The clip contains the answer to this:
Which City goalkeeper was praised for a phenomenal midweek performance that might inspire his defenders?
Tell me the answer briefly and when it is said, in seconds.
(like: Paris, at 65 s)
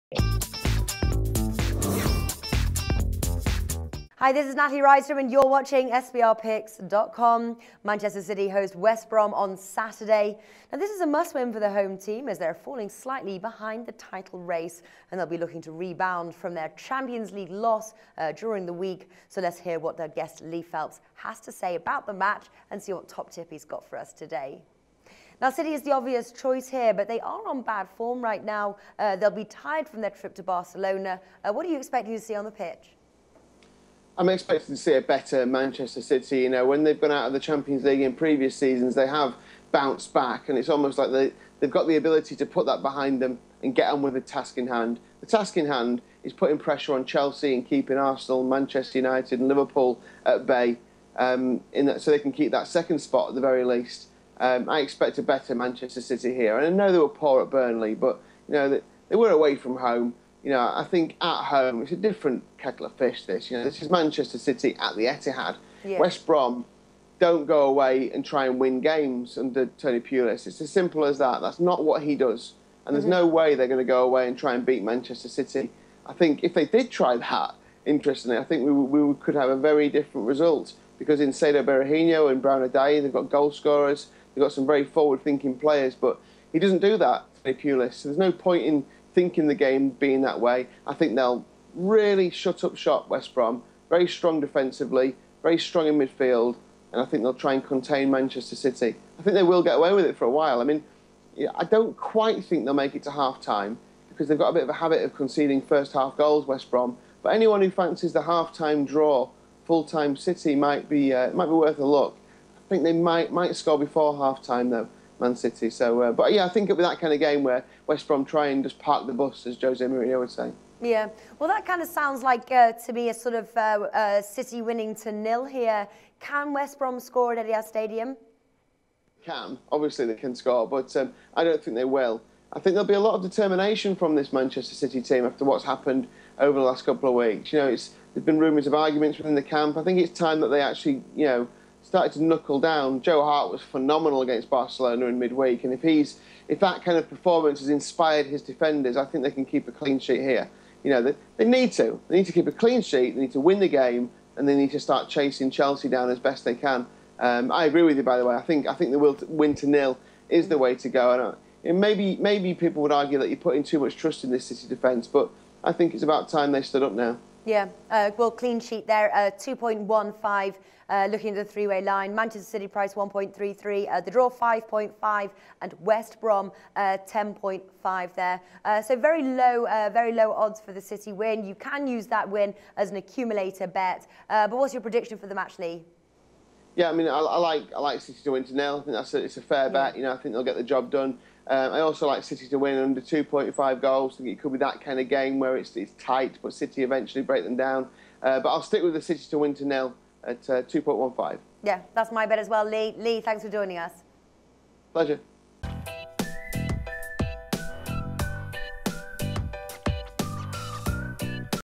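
Joe Hart, at 143 s.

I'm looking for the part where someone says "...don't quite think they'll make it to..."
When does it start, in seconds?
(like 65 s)
101 s.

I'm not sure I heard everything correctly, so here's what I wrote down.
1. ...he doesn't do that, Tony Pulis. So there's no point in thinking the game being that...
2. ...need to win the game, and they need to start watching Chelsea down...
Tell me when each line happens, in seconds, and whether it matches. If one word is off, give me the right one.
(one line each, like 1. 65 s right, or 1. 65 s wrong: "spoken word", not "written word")
1. 86 s right
2. 153 s wrong: "chasing", not "watching".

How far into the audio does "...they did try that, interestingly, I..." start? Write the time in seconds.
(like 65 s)
76 s.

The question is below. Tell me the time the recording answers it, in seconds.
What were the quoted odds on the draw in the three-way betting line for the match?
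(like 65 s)
174 s.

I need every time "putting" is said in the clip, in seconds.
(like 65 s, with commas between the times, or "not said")
46 s, 163 s.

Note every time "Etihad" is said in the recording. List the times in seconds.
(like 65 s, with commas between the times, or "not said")
65 s, 127 s.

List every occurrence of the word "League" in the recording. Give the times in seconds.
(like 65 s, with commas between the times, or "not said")
17 s, 37 s.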